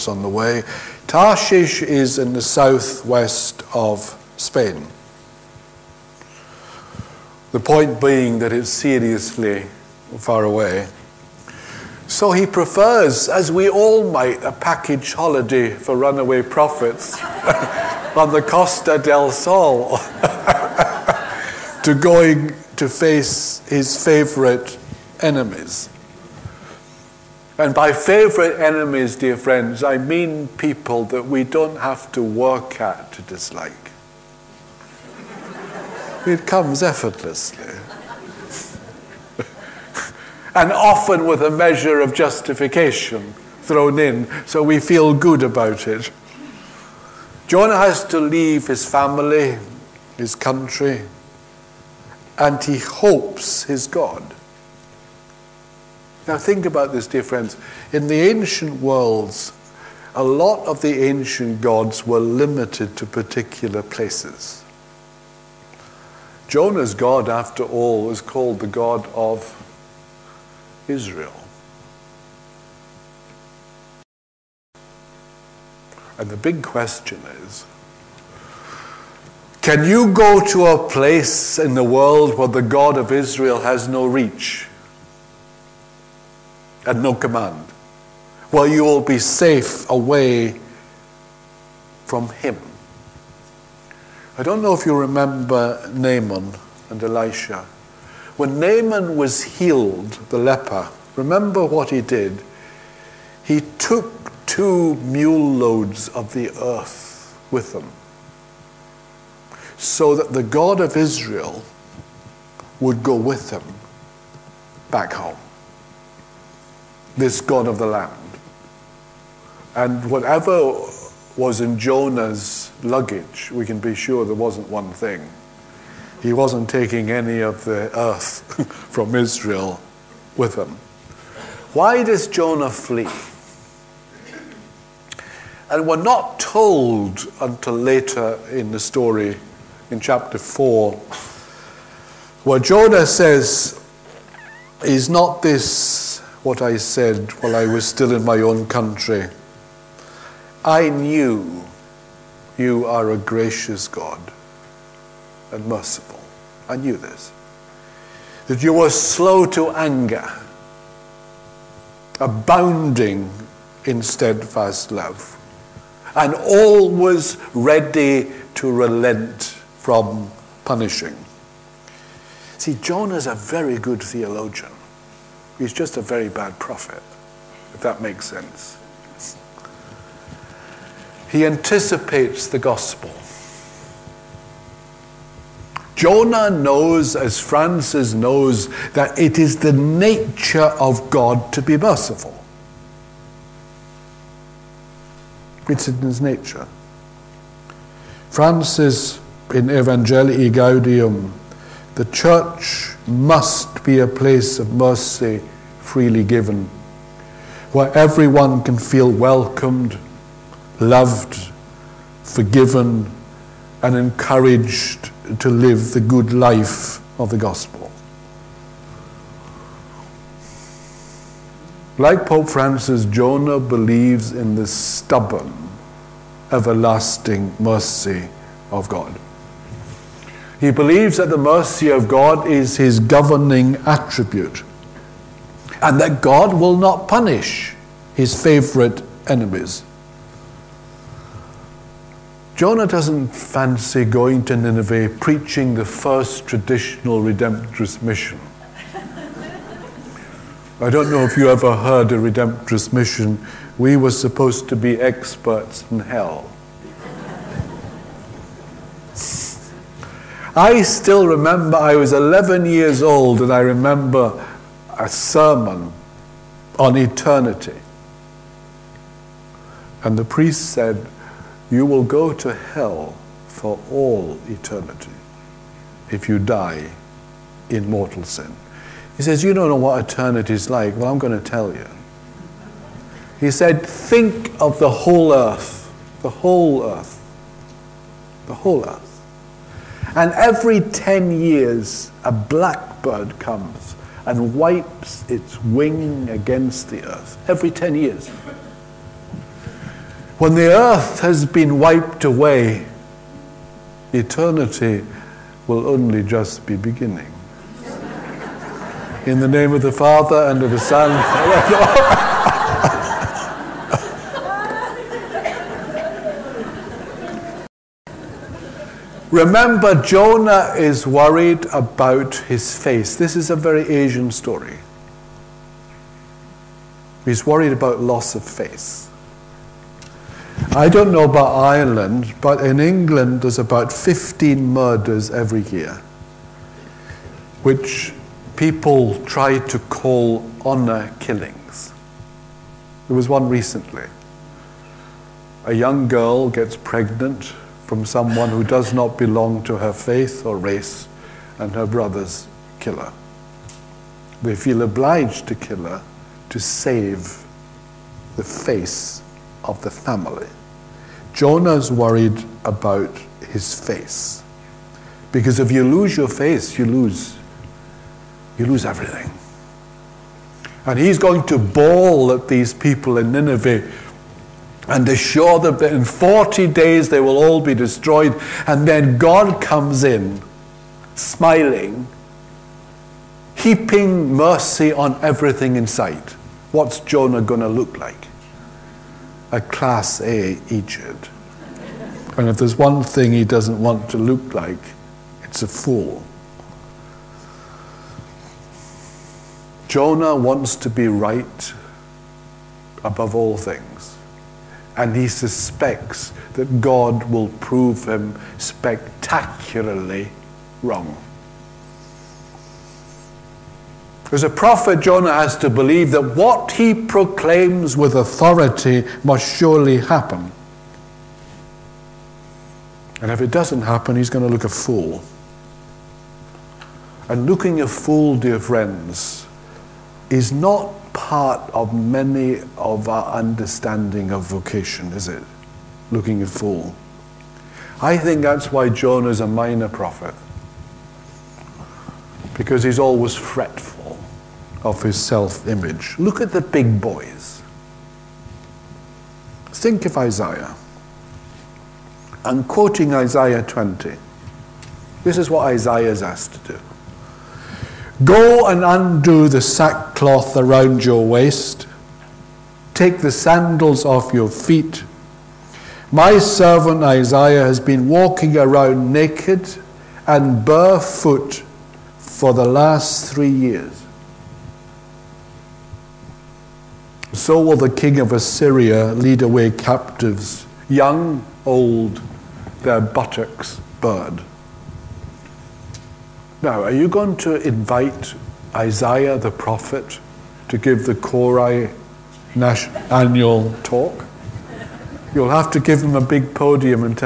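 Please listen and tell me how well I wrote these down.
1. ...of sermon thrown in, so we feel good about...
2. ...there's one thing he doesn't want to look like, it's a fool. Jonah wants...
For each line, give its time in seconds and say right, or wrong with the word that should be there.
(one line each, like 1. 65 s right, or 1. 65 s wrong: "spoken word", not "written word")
1. 42 s wrong: "justification", not "sermon"
2. 392 s right.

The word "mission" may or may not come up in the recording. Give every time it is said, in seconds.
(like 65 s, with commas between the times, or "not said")
248 s, 252 s.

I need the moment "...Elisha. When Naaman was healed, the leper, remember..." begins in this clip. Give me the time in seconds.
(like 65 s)
97 s.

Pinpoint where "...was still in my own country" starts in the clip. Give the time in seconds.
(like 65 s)
147 s.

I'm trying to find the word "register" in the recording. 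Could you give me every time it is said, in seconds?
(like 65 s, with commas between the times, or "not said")
not said.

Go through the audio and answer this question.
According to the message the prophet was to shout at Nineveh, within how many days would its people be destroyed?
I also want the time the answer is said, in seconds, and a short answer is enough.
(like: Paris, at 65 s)
40, at 376 s.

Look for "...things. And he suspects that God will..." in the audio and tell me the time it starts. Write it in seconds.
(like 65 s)
403 s.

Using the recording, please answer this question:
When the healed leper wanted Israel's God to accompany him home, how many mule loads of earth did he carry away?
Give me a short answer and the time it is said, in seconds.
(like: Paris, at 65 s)
2, at 104 s.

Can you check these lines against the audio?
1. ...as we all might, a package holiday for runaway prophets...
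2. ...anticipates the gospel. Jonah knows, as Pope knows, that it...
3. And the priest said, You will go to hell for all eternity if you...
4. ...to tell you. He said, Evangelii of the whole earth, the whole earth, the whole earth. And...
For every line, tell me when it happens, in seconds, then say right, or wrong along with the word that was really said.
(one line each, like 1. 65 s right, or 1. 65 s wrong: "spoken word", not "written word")
1. 13 s right
2. 181 s wrong: "Francis", not "Pope"
3. 270 s right
4. 281 s wrong: "Think", not "Evangelii".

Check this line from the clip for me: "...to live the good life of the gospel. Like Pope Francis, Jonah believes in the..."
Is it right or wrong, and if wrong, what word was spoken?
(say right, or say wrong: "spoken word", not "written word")
right.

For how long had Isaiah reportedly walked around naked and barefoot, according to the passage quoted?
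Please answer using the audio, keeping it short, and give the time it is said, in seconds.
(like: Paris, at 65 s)
3 years, at 473 s.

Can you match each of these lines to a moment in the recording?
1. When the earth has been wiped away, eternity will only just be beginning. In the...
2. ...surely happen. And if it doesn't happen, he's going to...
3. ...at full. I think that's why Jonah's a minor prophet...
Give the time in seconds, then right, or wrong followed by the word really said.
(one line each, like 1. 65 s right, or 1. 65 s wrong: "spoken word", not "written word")
1. 300 s right
2. 419 s right
3. 436 s right.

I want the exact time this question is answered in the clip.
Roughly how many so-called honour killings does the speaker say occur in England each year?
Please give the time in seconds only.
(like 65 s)
333 s.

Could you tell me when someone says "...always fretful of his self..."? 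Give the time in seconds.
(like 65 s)
442 s.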